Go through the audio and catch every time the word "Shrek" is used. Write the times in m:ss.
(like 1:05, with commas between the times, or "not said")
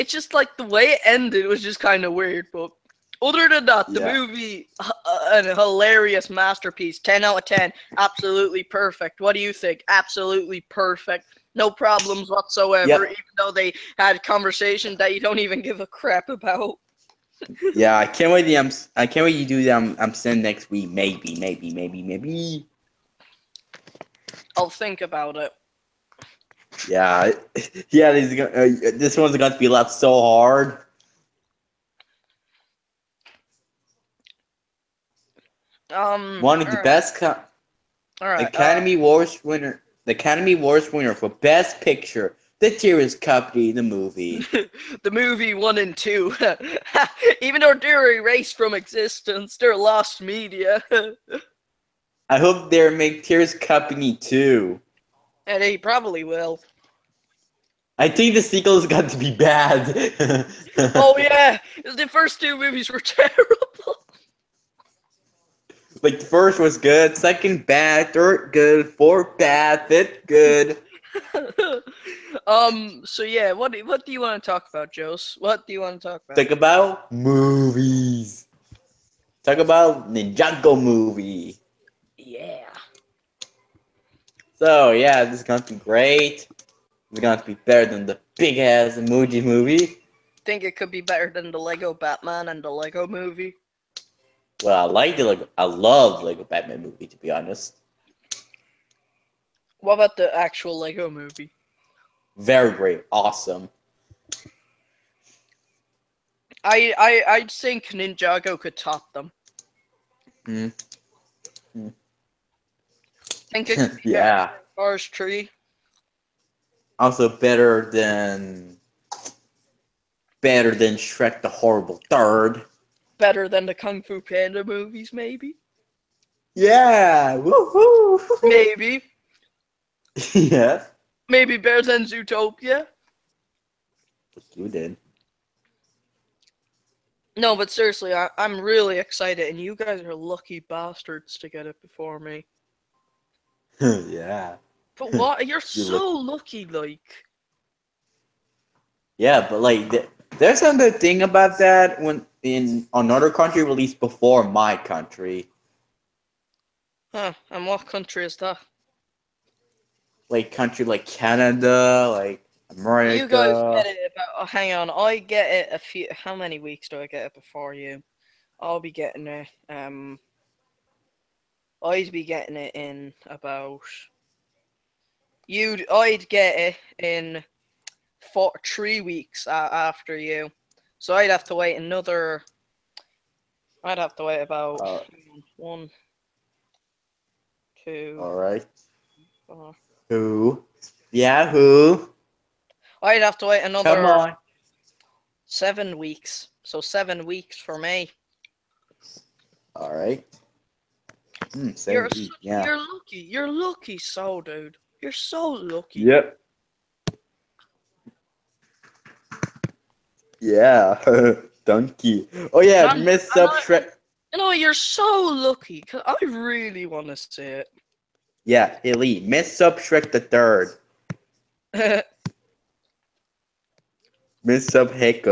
2:00, 3:33, 3:39.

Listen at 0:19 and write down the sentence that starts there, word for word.
Um, um, I'm, I'm sending next week.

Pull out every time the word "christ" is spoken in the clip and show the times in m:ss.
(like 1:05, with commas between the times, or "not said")
not said.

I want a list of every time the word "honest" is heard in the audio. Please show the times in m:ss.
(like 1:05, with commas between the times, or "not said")
1:37.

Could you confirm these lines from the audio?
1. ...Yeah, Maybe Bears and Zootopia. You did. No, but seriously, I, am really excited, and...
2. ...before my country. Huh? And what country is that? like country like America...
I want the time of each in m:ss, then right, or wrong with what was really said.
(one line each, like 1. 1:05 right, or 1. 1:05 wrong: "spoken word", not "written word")
1. 2:10 right
2. 2:33 wrong: "Canada", not "America".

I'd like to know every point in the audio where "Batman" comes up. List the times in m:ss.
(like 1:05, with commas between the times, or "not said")
1:31, 1:36.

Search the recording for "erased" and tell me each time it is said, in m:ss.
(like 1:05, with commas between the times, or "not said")
0:48.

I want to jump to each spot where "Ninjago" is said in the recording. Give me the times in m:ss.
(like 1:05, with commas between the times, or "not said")
1:20, 1:47.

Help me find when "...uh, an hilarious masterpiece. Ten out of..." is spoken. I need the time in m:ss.
0:04.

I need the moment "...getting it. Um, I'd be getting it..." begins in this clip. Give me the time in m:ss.
2:48.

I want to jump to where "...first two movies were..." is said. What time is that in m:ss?
1:02.